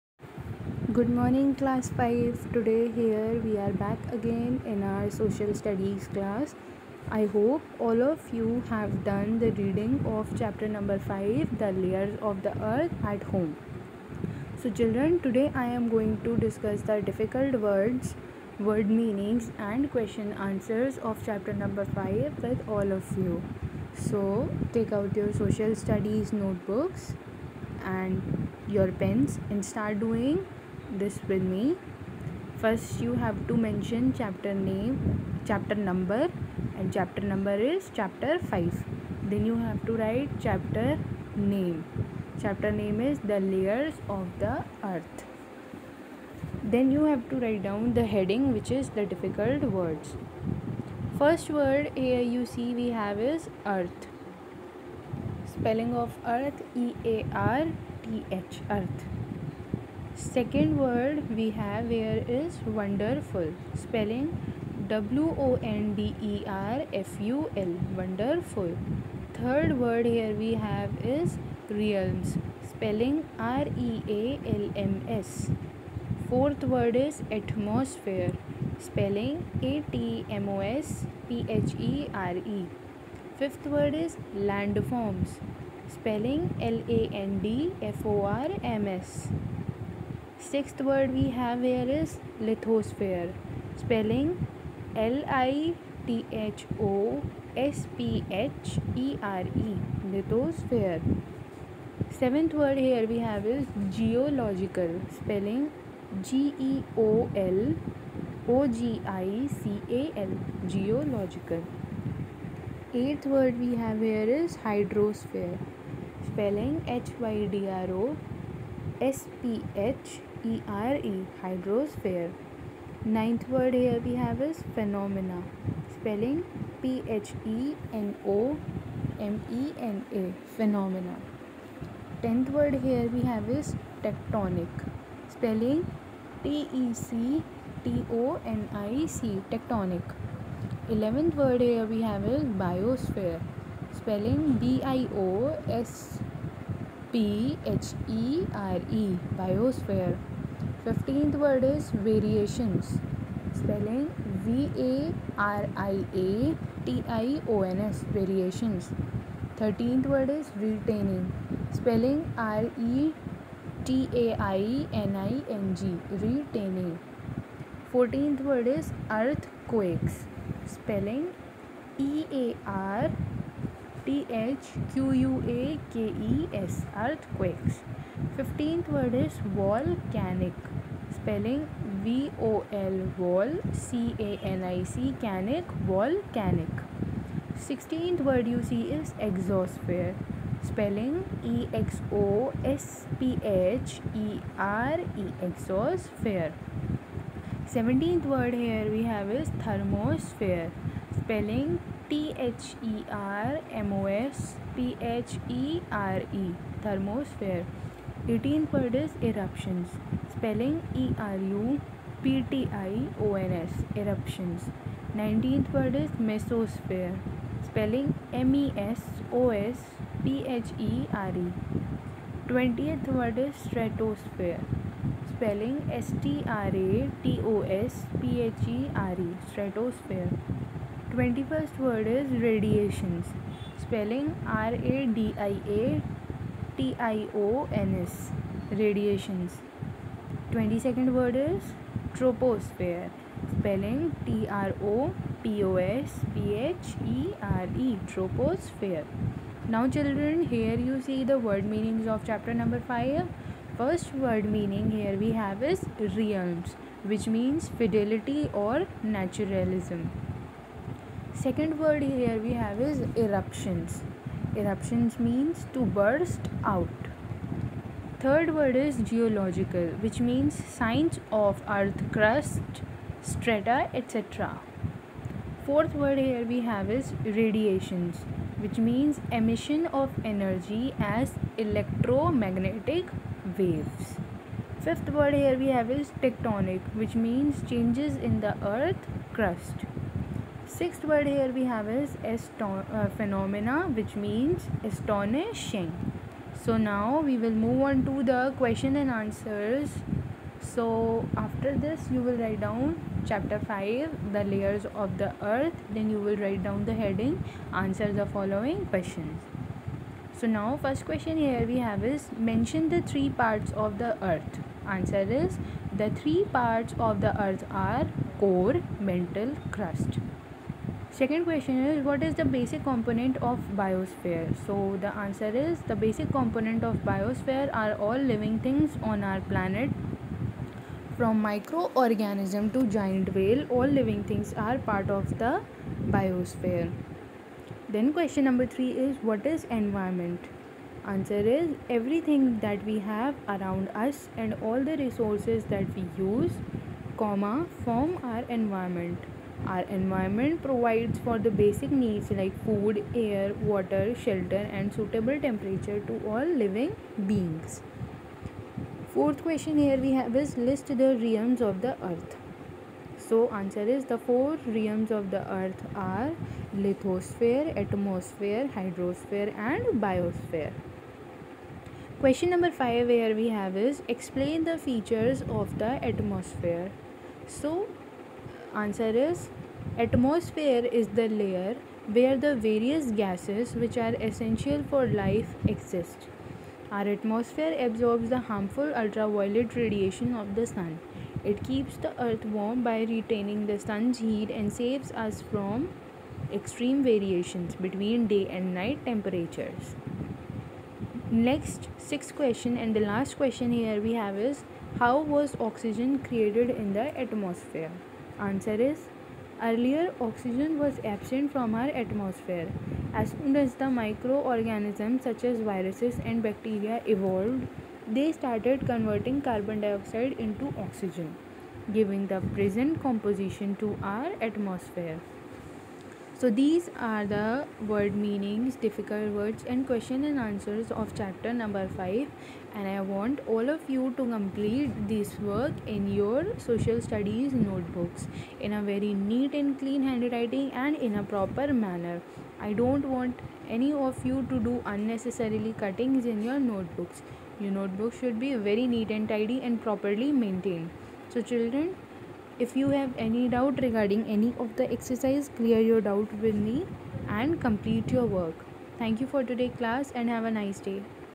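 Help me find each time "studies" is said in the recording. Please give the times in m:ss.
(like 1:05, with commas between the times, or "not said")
0:05, 0:25, 7:16.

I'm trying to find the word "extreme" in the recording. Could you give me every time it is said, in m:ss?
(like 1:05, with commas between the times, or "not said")
6:36.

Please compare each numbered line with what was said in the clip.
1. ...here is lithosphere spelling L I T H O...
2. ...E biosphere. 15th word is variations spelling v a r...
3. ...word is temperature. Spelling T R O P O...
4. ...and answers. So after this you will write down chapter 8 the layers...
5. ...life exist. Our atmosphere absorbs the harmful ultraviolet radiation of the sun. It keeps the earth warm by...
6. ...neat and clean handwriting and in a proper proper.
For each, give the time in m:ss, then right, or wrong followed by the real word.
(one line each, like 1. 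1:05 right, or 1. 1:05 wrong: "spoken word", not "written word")
1. 1:31 right
2. 2:28 right
3. 4:01 wrong: "troposphere", not "temperature"
4. 4:58 wrong: "5", not "8"
5. 6:25 right
6. 7:19 wrong: "manner", not "proper".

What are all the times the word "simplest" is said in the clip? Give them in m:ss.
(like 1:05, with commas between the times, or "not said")
not said.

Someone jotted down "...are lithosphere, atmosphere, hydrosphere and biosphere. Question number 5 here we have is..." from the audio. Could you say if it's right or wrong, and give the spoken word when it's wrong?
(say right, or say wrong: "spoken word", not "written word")
right.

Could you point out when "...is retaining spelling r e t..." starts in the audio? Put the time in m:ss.
2:40.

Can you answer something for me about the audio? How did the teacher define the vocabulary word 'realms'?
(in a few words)
fidelity or naturalism.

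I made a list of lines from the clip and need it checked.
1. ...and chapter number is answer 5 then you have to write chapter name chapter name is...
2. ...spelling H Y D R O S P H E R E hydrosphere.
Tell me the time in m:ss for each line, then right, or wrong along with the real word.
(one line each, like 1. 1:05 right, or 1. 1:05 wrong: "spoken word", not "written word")
1. 0:36 wrong: "chapter", not "answer"
2. 1:56 right.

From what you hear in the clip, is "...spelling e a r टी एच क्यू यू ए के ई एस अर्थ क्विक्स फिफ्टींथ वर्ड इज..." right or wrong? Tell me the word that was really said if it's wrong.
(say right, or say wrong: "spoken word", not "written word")
right.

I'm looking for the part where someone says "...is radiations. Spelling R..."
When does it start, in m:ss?
3:52.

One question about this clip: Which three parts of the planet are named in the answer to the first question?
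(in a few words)
core, mantle, crust.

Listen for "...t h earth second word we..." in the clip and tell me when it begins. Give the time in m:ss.
0:58.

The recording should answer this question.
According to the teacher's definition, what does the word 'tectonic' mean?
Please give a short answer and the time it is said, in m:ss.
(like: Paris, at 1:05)
changes in the earth crust, at 4:47.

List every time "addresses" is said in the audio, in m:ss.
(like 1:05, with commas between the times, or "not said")
not said.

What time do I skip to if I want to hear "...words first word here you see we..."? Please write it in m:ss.
0:49.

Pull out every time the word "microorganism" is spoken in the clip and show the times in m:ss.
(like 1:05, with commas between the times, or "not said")
5:31, 6:53.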